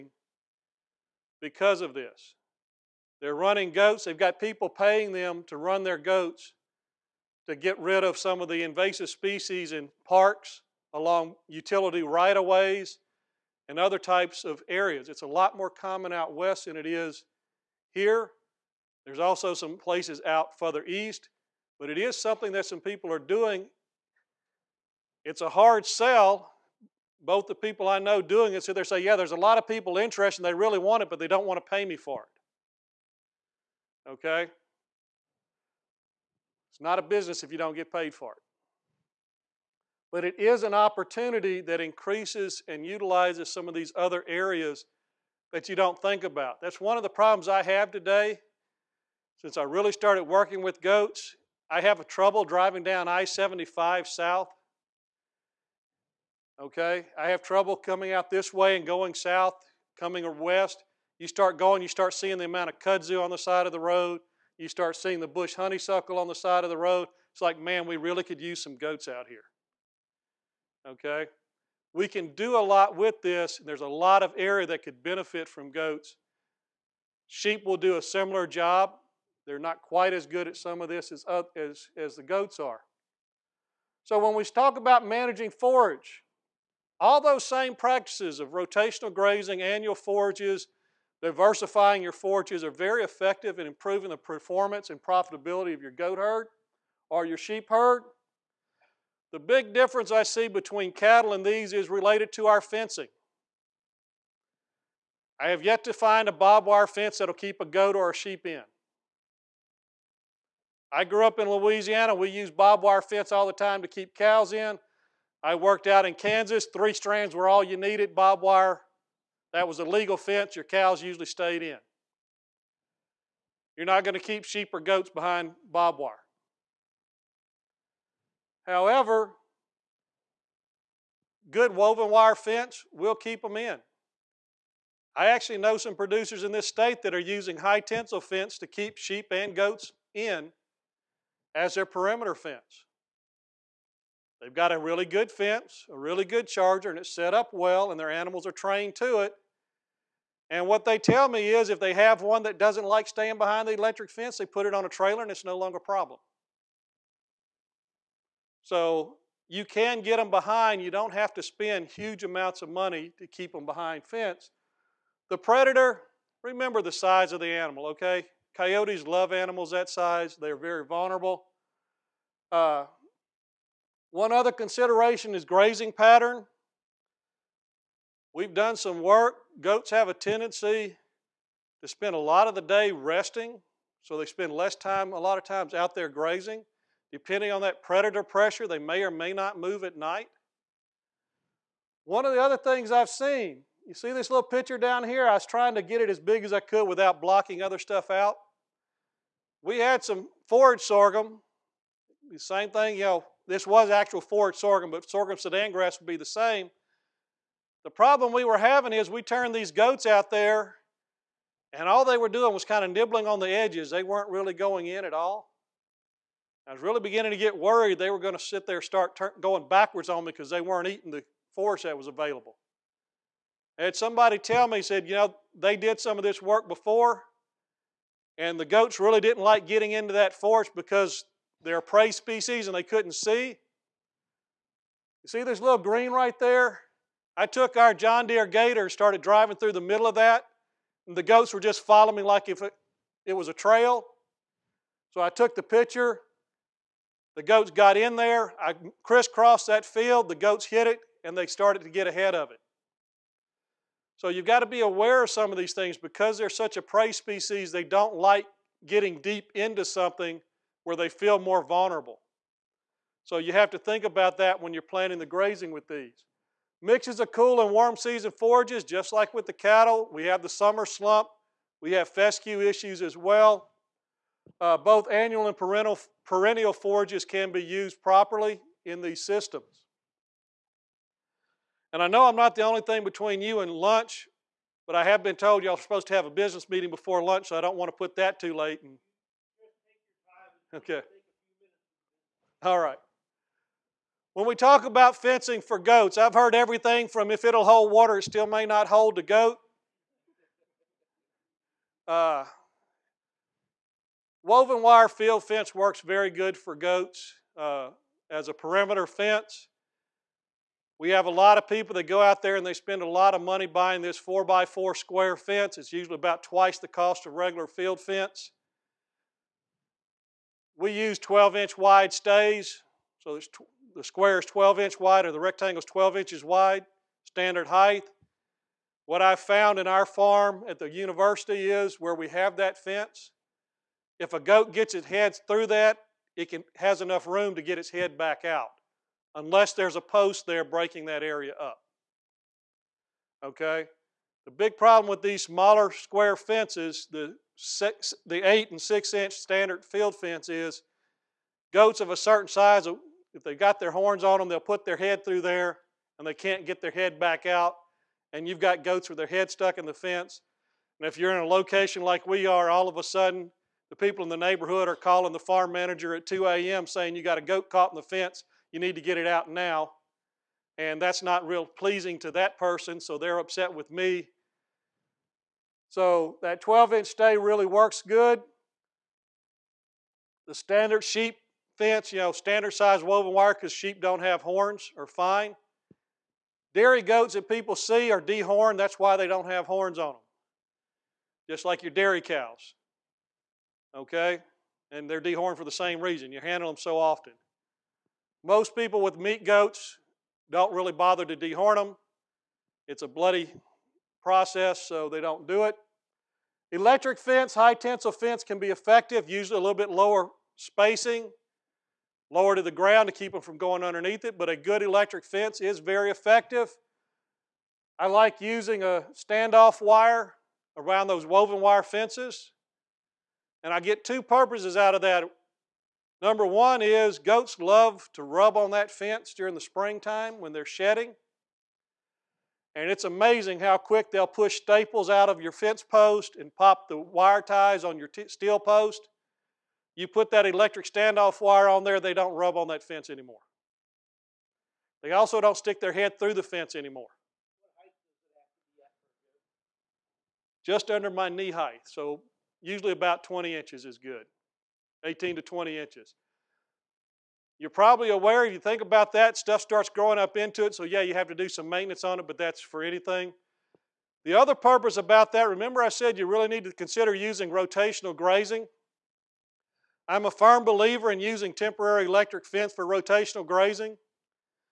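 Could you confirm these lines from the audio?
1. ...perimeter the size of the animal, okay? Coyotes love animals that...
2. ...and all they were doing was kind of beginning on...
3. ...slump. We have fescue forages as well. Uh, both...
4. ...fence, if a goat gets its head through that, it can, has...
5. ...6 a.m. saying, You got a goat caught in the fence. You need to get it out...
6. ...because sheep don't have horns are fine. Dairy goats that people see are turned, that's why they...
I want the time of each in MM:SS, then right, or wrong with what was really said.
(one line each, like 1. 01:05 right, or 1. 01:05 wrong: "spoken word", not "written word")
1. 02:46 wrong: "remember", not "perimeter"
2. 03:31 wrong: "nibbling", not "beginning"
3. 04:30 wrong: "issues", not "forages"
4. 05:32 right
5. 06:06 wrong: "2", not "6"
6. 06:23 wrong: "dehorned", not "turned".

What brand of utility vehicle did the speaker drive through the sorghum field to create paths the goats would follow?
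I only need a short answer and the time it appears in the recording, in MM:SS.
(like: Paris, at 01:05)
John Deere, at 03:57.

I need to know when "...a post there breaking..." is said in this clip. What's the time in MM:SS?
05:39.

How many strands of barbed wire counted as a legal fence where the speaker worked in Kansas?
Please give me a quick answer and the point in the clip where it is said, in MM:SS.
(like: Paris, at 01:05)
3, at 01:56.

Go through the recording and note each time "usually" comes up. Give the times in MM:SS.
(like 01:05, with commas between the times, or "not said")
02:01, 05:15, 06:49, 07:32.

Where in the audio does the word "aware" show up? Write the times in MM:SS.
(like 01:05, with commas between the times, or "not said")
04:14, 07:38.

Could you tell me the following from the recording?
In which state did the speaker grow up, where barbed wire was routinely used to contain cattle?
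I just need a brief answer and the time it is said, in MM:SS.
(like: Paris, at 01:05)
Louisiana, at 01:51.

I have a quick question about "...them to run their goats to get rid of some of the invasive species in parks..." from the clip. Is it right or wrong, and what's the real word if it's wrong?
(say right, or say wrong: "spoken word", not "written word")
right.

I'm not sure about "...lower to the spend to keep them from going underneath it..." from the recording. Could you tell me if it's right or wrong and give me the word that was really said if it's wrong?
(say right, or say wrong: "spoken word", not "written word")
wrong: "ground", not "spend".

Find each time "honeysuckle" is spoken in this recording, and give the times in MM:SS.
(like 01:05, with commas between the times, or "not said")
01:05.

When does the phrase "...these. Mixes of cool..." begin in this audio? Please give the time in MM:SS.
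04:25.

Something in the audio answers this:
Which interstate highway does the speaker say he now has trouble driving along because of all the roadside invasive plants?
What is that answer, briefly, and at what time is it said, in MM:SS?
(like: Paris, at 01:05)
I-75, at 00:53.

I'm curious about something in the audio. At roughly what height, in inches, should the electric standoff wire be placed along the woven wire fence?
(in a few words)
18 to 20 inches.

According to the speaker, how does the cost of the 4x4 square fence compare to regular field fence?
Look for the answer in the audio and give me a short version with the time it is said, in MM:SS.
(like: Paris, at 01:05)
twice the cost, at 05:16.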